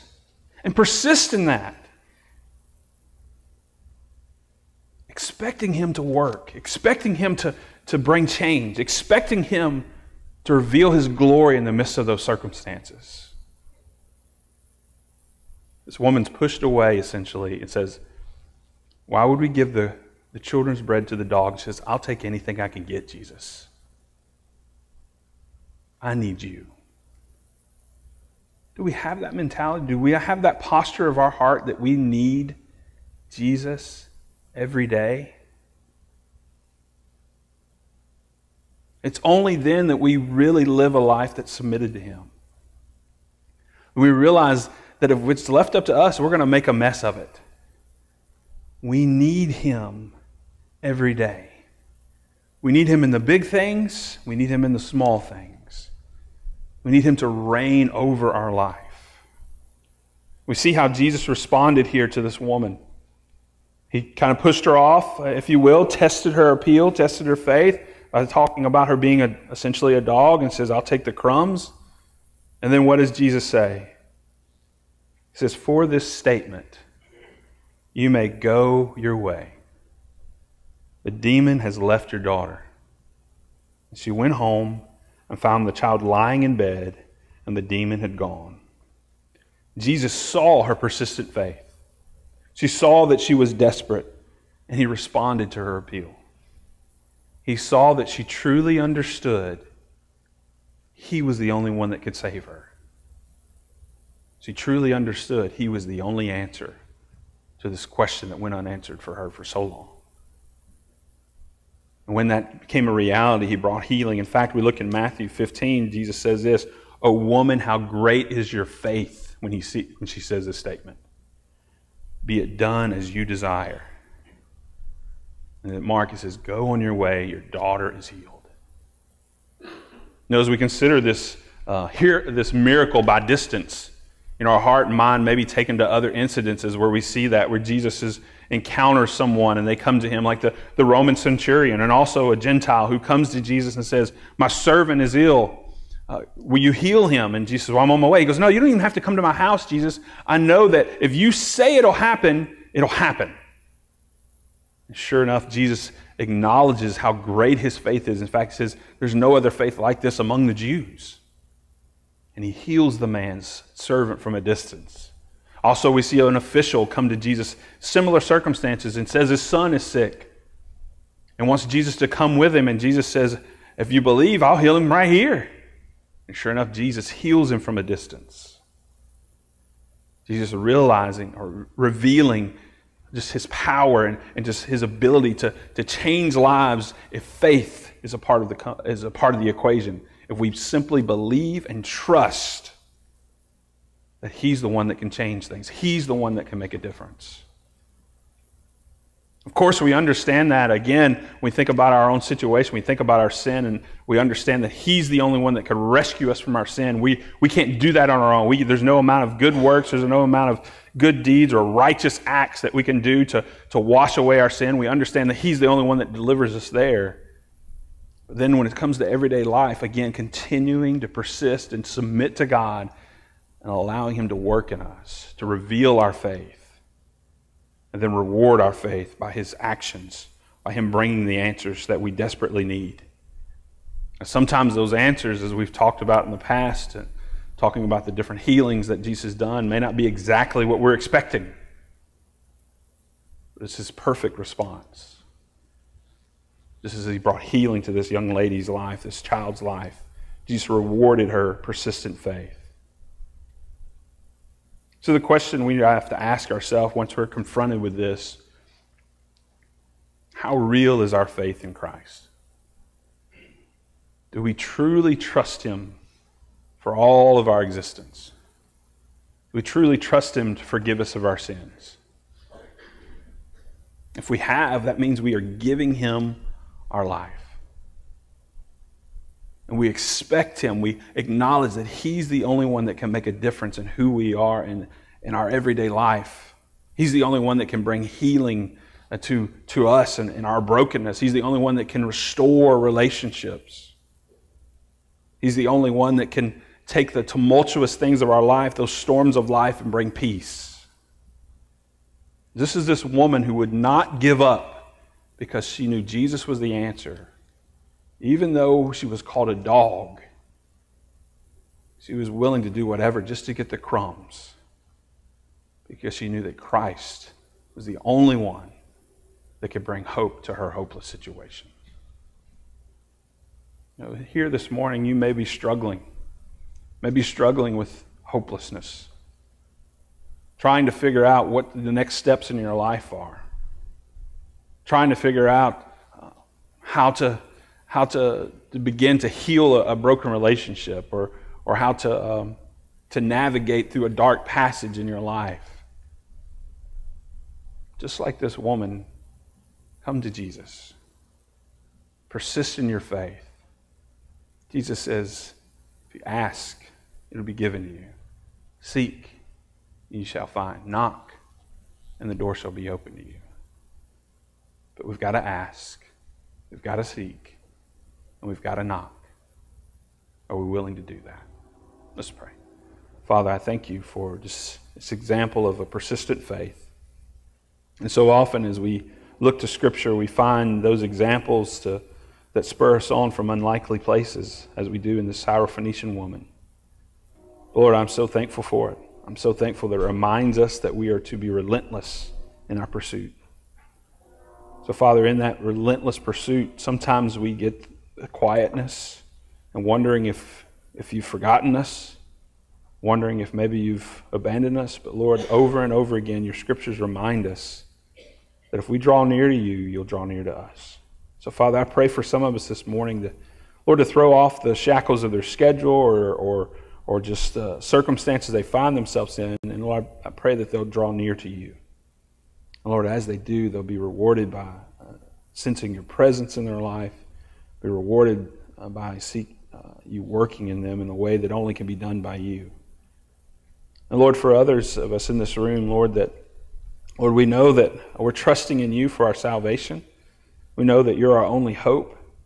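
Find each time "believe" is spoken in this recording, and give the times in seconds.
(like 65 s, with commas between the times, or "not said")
174 s, 191 s.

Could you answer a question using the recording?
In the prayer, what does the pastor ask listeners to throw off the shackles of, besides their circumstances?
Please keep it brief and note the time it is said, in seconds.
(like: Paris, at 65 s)
Their schedule, at 415 s.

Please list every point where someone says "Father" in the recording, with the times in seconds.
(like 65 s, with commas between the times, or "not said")
373 s, 394 s, 411 s.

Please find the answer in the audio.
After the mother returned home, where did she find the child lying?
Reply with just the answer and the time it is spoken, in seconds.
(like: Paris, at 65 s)
In bed, at 86 s.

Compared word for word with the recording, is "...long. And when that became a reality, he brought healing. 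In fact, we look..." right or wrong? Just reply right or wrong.
right.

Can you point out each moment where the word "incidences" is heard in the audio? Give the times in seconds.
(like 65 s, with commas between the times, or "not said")
136 s.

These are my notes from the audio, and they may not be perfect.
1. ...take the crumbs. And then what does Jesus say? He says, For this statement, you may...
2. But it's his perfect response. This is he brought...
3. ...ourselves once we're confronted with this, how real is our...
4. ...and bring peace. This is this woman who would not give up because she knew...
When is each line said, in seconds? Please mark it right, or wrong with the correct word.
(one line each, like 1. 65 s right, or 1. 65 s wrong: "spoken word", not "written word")
1. 70 s right
2. 243 s right
3. 256 s right
4. 299 s right.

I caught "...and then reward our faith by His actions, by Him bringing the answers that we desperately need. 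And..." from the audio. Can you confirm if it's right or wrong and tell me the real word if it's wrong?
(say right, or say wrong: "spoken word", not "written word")
right.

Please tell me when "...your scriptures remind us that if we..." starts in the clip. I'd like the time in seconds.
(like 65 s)
406 s.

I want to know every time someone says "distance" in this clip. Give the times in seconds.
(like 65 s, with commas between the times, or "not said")
133 s, 164 s, 177 s.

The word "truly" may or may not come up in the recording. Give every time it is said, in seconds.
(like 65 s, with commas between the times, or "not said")
98 s, 104 s, 264 s, 269 s.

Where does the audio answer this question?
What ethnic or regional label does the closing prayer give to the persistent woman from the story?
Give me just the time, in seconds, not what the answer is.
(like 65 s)
385 s.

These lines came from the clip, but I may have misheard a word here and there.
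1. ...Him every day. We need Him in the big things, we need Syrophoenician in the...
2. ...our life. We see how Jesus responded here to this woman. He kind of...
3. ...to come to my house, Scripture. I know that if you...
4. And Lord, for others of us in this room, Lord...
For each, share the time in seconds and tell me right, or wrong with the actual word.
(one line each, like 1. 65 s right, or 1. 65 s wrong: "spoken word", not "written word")
1. 49 s wrong: "Him", not "Syrophoenician"
2. 58 s right
3. 148 s wrong: "Jesus", not "Scripture"
4. 434 s right.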